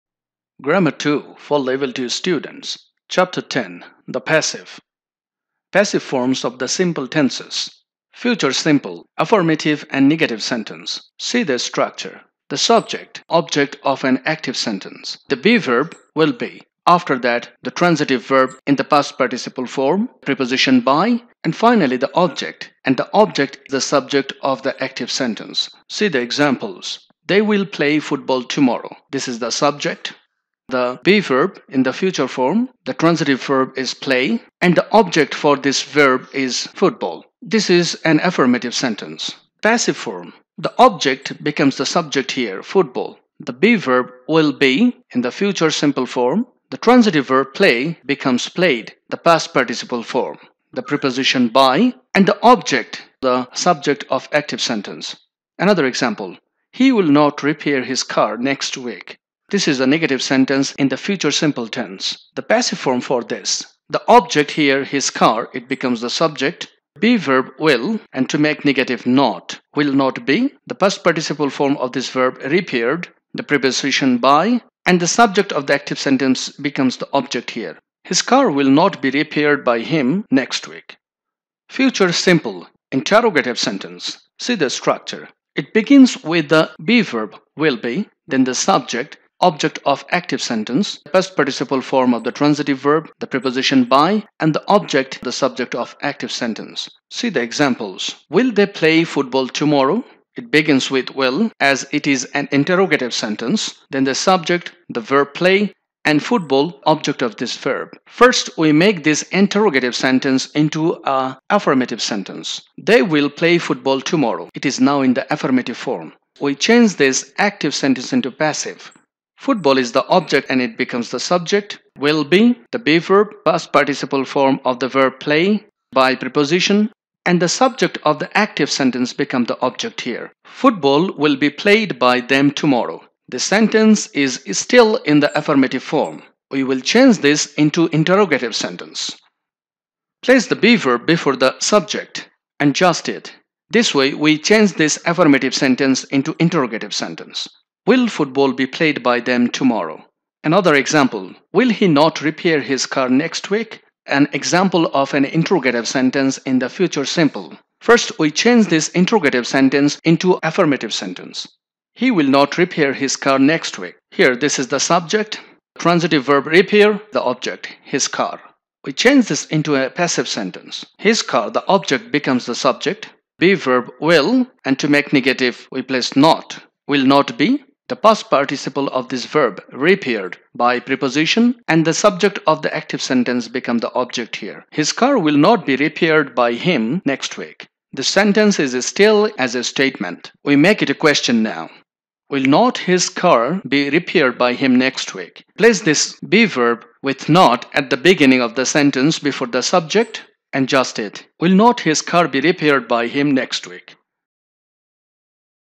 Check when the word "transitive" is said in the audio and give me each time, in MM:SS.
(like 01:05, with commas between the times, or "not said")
00:17, 00:32, 00:46, 01:32, 02:45.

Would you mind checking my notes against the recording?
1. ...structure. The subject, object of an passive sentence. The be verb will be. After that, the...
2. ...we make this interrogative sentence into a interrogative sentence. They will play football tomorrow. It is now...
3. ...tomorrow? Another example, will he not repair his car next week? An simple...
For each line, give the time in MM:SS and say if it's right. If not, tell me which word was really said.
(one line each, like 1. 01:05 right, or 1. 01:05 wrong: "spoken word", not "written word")
1. 00:11 wrong: "active", not "passive"
2. 01:48 wrong: "affirmative", not "interrogative"
3. 02:29 wrong: "example", not "simple".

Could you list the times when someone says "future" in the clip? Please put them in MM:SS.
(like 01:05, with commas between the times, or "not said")
00:08, 00:31, 00:45, 01:00, 01:21, 02:36.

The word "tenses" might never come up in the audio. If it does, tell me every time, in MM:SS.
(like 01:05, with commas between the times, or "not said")
00:07, 01:01.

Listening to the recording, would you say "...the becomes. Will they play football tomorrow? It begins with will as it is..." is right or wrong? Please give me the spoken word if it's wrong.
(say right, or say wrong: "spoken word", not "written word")
wrong: "examples", not "becomes".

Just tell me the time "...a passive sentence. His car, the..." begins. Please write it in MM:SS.
02:49.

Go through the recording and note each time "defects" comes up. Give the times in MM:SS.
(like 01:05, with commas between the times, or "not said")
not said.